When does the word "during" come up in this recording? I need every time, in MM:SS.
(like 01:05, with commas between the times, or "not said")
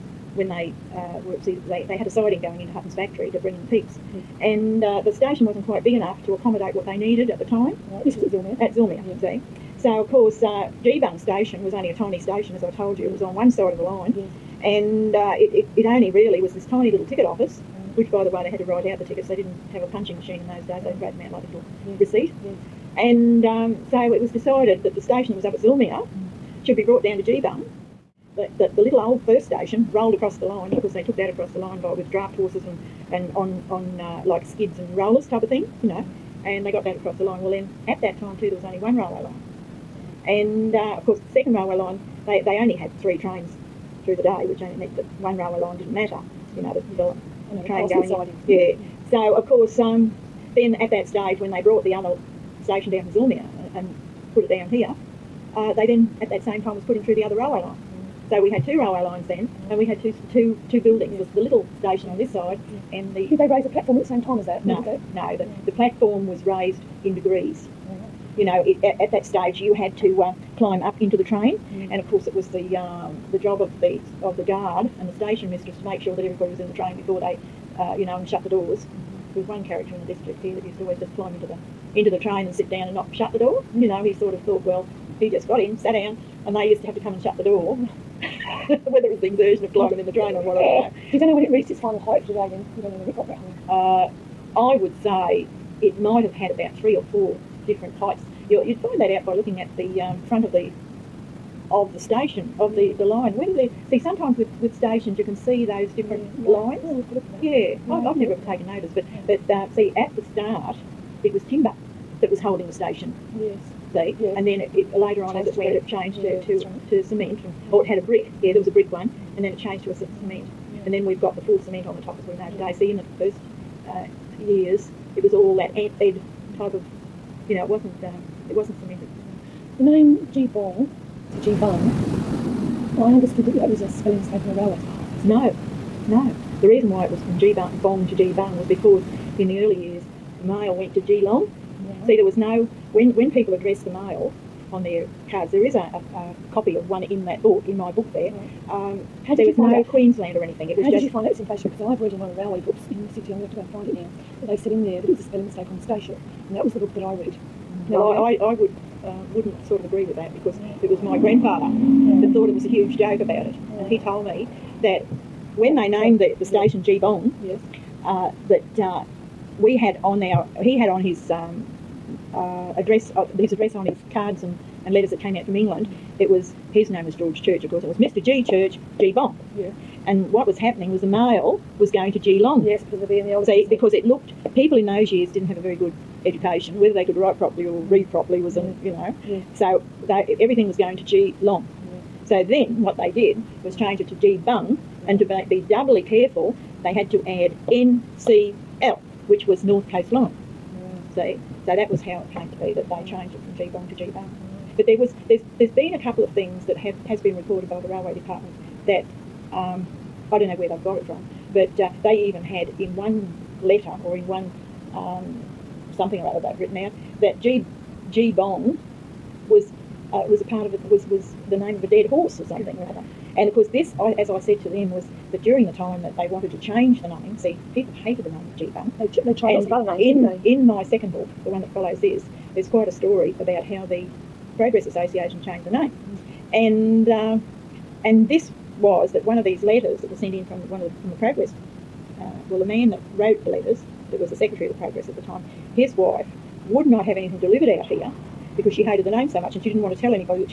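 03:45.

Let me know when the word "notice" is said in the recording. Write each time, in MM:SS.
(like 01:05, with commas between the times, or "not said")
01:48.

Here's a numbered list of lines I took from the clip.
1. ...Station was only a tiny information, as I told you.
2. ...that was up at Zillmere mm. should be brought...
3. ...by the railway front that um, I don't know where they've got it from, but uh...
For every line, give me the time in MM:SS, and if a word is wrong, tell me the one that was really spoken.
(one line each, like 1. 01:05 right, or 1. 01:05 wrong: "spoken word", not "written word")
1. 00:11 wrong: "station", not "information"
2. 00:25 right
3. 03:27 wrong: "department", not "front".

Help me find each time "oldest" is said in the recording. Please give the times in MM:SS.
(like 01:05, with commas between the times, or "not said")
03:03.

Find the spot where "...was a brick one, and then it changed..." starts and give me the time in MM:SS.
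01:58.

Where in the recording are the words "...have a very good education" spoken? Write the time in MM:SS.
03:05.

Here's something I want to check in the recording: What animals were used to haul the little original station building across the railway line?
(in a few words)
draft horses.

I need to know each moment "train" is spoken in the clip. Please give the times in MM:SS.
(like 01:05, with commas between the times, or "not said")
00:43, 00:47, 01:11, 01:16, 01:22, 01:30.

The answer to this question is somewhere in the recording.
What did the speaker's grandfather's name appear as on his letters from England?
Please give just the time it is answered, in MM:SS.
02:57.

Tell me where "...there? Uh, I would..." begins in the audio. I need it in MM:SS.
01:33.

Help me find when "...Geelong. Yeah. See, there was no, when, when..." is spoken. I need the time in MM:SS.
02:20.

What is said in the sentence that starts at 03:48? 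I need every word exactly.
They, they tried and lots of other names.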